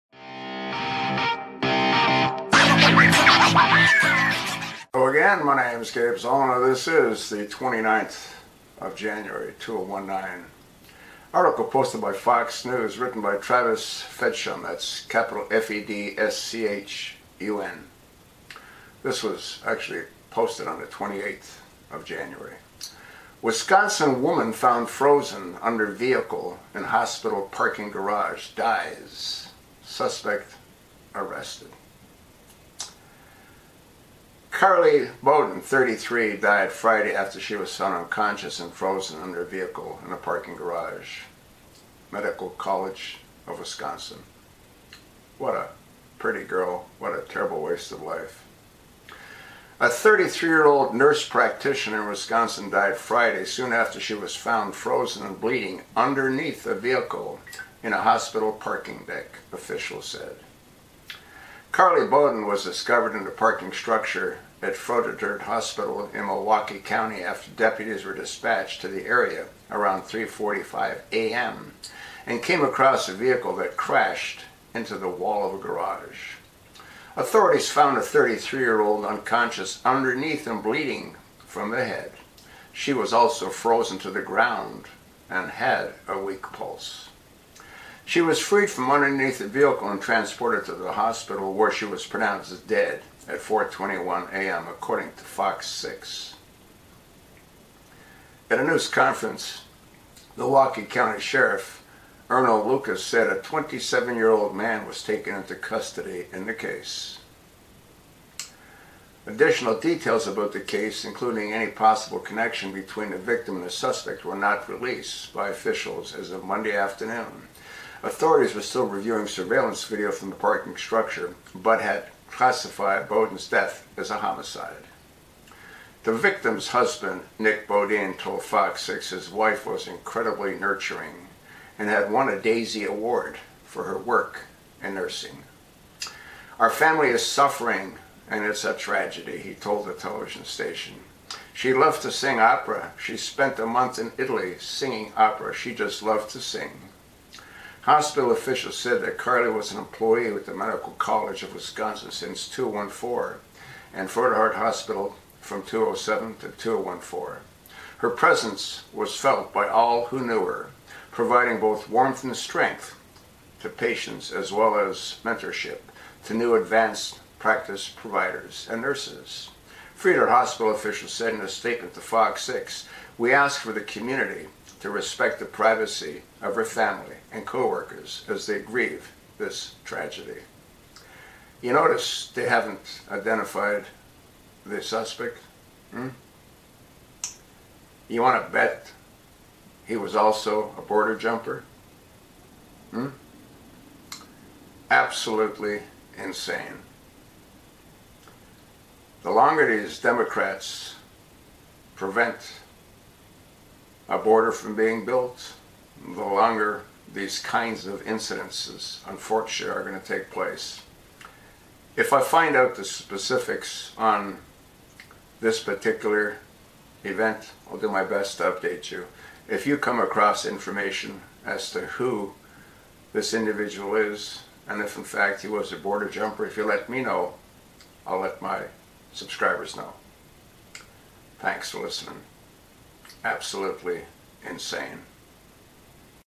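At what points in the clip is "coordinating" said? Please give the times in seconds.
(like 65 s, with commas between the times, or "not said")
not said.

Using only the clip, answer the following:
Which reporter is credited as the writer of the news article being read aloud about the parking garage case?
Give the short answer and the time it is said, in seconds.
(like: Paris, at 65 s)
Travis Fedschun, at 13 s.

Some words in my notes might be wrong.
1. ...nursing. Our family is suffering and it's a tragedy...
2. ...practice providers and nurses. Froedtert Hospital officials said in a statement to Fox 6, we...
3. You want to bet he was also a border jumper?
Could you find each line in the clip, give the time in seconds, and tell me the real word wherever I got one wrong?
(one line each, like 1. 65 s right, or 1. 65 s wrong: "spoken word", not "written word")
1. 134 s right
2. 167 s right
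3. 188 s right.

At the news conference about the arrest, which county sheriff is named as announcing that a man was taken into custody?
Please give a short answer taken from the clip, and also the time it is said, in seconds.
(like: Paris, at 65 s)
Earnell Lucas, at 102 s.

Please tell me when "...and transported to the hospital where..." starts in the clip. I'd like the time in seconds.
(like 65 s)
89 s.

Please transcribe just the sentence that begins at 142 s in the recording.
She spent a month in Italy singing opera.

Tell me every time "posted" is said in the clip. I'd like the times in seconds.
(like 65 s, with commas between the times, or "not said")
11 s, 20 s.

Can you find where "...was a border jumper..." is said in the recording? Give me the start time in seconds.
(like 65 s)
225 s.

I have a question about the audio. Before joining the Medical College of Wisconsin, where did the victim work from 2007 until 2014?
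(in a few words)
Florida Heart Hospital.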